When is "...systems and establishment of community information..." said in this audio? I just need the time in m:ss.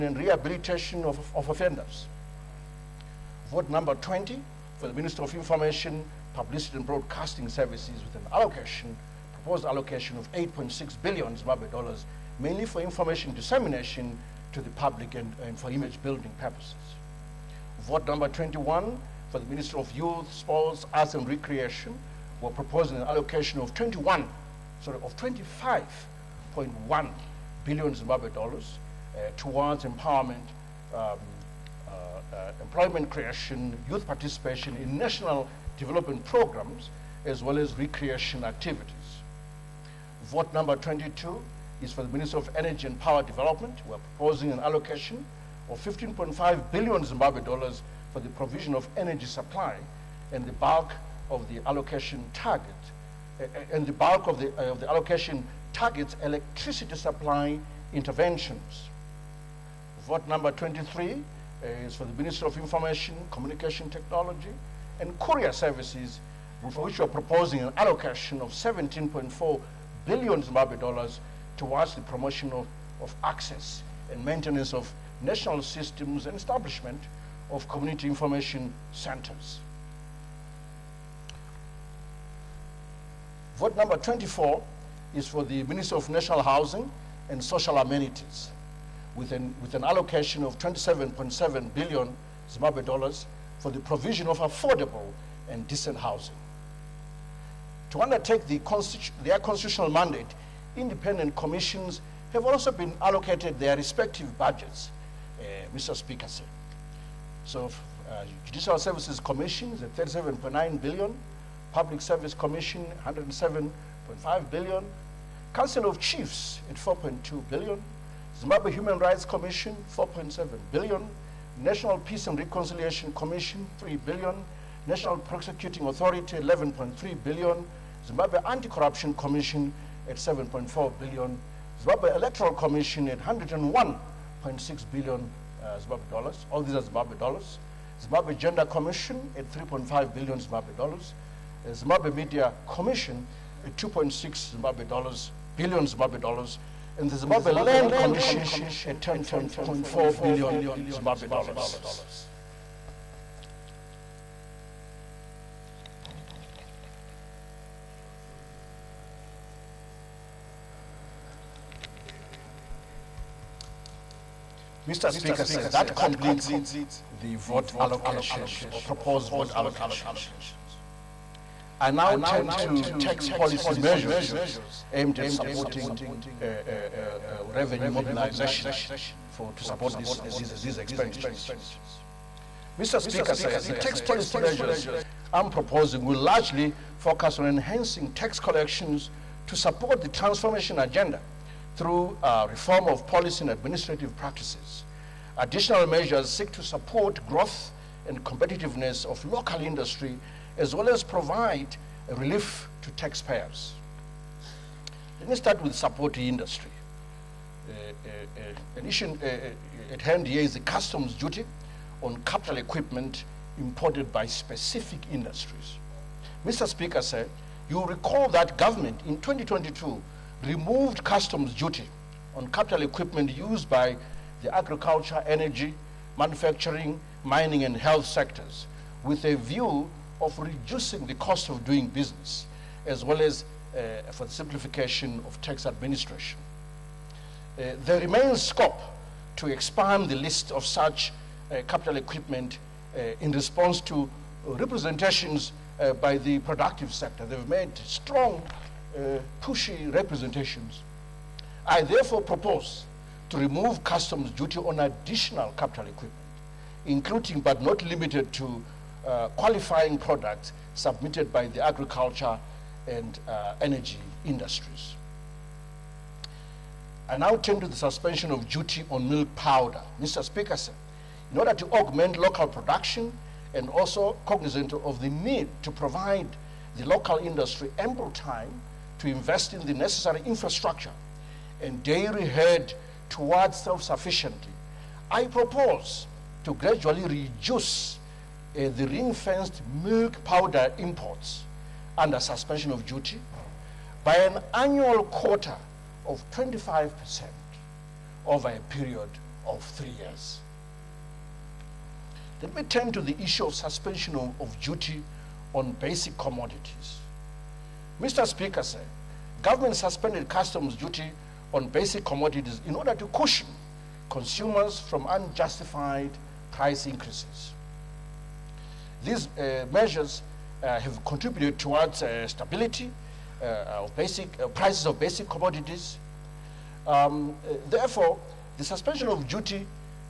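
1:15.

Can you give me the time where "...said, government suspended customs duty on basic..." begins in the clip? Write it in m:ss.
5:08.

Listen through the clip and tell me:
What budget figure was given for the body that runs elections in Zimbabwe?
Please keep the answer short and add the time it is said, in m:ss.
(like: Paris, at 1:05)
101.6 billion, at 2:13.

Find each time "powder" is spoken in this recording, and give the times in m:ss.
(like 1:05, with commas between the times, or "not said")
4:29, 4:50.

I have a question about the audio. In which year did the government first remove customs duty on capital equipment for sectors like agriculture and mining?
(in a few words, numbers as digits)
2022.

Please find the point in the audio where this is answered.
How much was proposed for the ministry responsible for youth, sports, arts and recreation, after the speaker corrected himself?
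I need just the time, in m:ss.
0:25.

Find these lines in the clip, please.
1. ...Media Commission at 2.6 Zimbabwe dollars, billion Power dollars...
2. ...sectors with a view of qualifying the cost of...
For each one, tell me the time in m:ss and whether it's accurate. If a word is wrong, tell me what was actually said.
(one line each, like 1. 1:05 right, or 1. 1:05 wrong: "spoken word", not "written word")
1. 2:22 wrong: "Zimbabwe", not "Power"
2. 3:48 wrong: "reducing", not "qualifying".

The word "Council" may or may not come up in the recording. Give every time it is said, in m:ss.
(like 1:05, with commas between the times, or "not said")
1:55.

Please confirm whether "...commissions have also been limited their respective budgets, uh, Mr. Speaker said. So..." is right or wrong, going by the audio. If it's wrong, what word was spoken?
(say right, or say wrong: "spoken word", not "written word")
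wrong: "allocated", not "limited".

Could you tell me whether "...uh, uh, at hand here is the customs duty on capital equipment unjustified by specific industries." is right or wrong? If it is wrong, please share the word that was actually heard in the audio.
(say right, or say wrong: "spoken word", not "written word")
wrong: "imported", not "unjustified".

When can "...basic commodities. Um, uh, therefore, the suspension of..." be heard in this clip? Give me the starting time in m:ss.
5:24.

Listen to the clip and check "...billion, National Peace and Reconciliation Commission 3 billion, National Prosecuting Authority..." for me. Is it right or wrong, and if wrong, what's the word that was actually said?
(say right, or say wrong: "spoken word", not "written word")
right.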